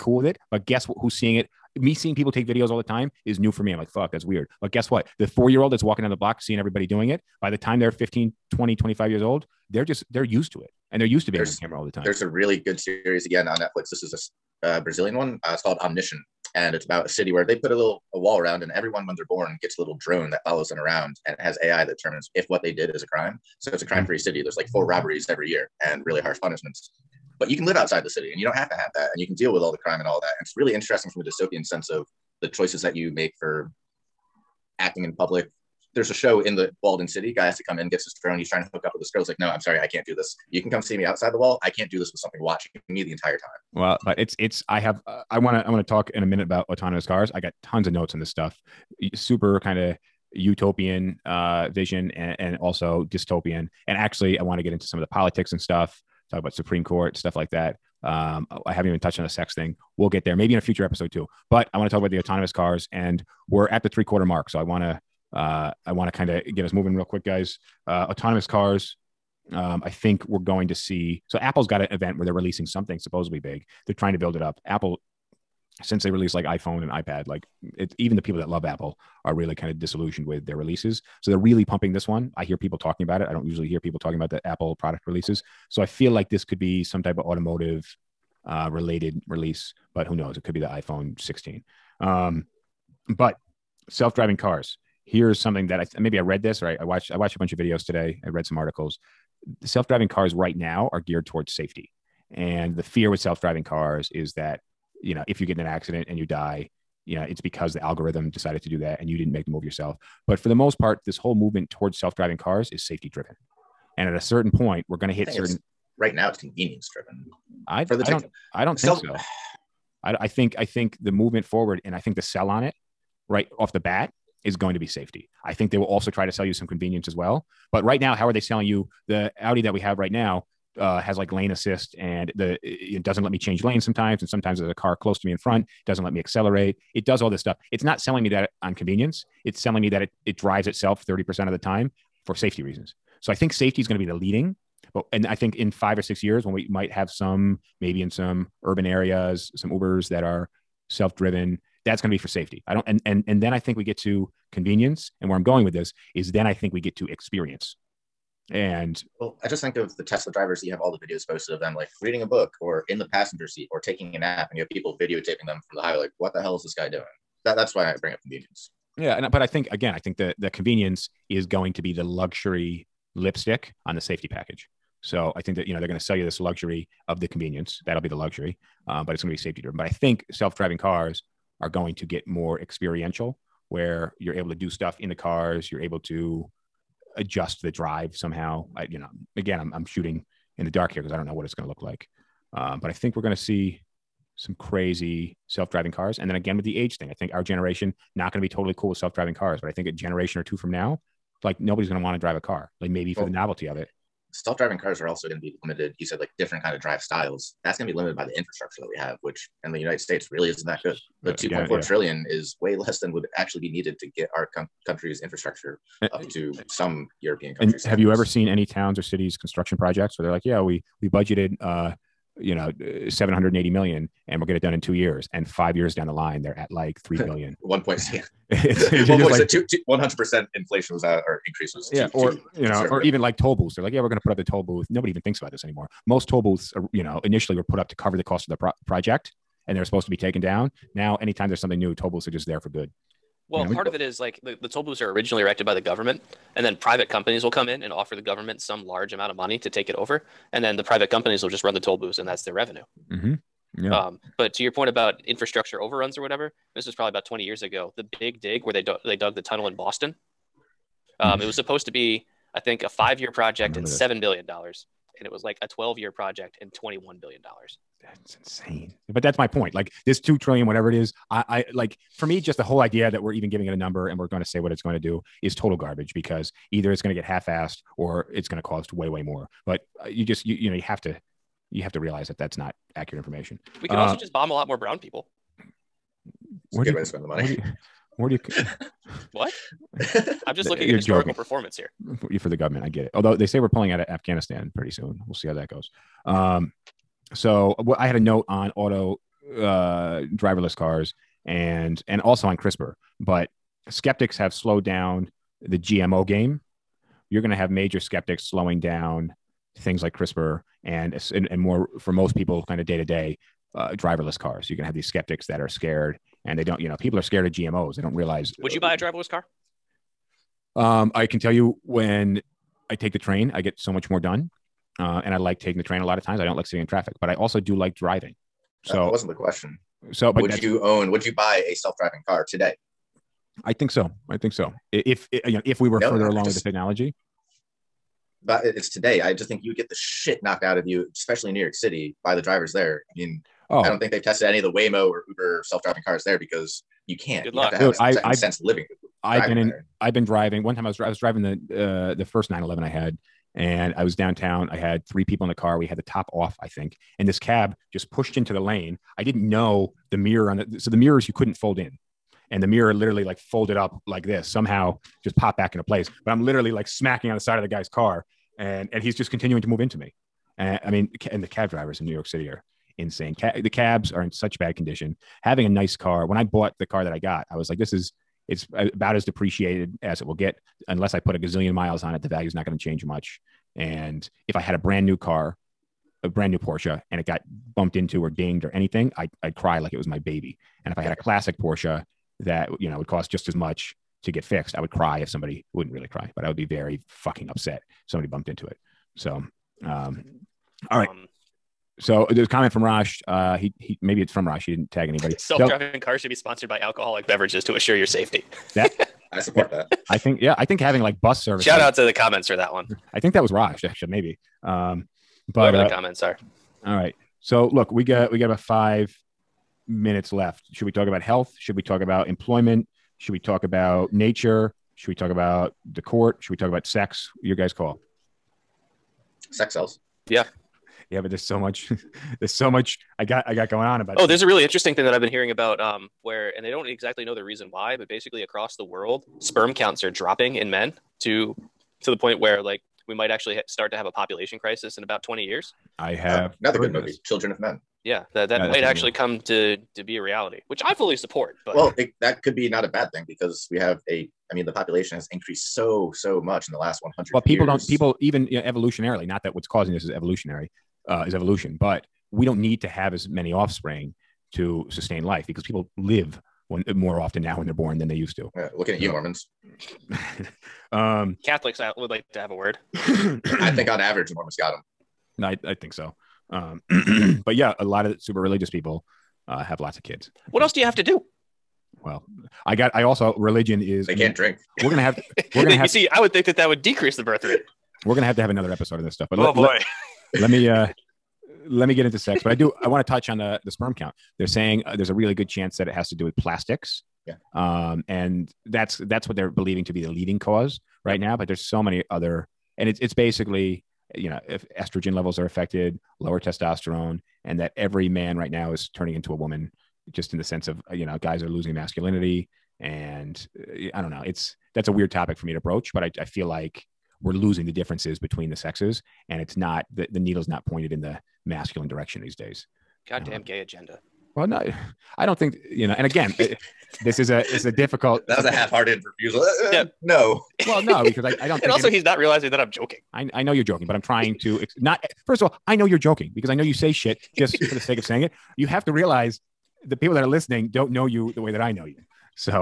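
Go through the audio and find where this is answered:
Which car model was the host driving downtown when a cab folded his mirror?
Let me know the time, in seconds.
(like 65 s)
352 s.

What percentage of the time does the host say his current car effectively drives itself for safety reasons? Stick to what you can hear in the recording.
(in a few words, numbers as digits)
30%.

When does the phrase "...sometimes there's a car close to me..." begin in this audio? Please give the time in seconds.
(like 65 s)
134 s.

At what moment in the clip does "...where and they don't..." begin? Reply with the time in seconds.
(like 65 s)
436 s.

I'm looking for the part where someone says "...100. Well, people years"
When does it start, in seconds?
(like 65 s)
457 s.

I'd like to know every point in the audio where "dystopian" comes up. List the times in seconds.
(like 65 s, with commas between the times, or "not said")
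31 s, 53 s.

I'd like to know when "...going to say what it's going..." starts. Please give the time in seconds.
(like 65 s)
274 s.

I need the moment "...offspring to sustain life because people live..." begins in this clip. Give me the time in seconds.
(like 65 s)
463 s.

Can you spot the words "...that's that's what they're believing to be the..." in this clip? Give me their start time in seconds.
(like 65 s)
498 s.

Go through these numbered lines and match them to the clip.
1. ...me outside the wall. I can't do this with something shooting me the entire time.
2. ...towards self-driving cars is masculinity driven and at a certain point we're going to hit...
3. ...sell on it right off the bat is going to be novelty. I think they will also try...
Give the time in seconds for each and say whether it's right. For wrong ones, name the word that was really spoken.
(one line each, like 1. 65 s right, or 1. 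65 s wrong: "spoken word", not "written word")
1. 40 s wrong: "watching", not "shooting"
2. 111 s wrong: "safety", not "masculinity"
3. 122 s wrong: "safety", not "novelty".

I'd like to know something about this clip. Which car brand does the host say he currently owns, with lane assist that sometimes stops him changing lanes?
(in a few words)
Audi.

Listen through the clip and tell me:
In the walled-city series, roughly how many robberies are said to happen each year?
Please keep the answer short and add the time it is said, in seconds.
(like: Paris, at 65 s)
4, at 24 s.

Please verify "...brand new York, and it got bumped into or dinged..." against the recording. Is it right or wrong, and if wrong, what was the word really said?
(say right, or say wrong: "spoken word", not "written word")
wrong: "Porsche", not "York".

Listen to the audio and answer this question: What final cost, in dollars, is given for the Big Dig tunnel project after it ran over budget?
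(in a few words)
$21 billion.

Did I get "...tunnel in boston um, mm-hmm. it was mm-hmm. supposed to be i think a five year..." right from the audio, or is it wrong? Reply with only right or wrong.
right.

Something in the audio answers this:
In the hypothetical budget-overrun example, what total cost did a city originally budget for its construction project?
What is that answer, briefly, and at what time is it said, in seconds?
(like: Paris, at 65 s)
$780 million, at 223 s.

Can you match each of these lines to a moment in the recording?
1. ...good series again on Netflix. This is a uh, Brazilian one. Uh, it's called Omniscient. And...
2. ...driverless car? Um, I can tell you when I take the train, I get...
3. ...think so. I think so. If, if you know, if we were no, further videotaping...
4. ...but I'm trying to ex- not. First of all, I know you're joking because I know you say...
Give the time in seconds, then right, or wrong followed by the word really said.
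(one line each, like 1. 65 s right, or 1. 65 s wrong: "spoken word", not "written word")
1. 12 s right
2. 318 s right
3. 333 s wrong: "along", not "videotaping"
4. 533 s right.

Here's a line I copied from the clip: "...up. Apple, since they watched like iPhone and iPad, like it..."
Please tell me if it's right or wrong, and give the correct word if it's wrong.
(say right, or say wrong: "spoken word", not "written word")
wrong: "released", not "watched".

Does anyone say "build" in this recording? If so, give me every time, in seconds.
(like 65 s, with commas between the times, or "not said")
74 s.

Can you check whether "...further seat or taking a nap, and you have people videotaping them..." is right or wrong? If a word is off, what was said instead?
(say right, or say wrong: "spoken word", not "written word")
wrong: "passenger", not "further".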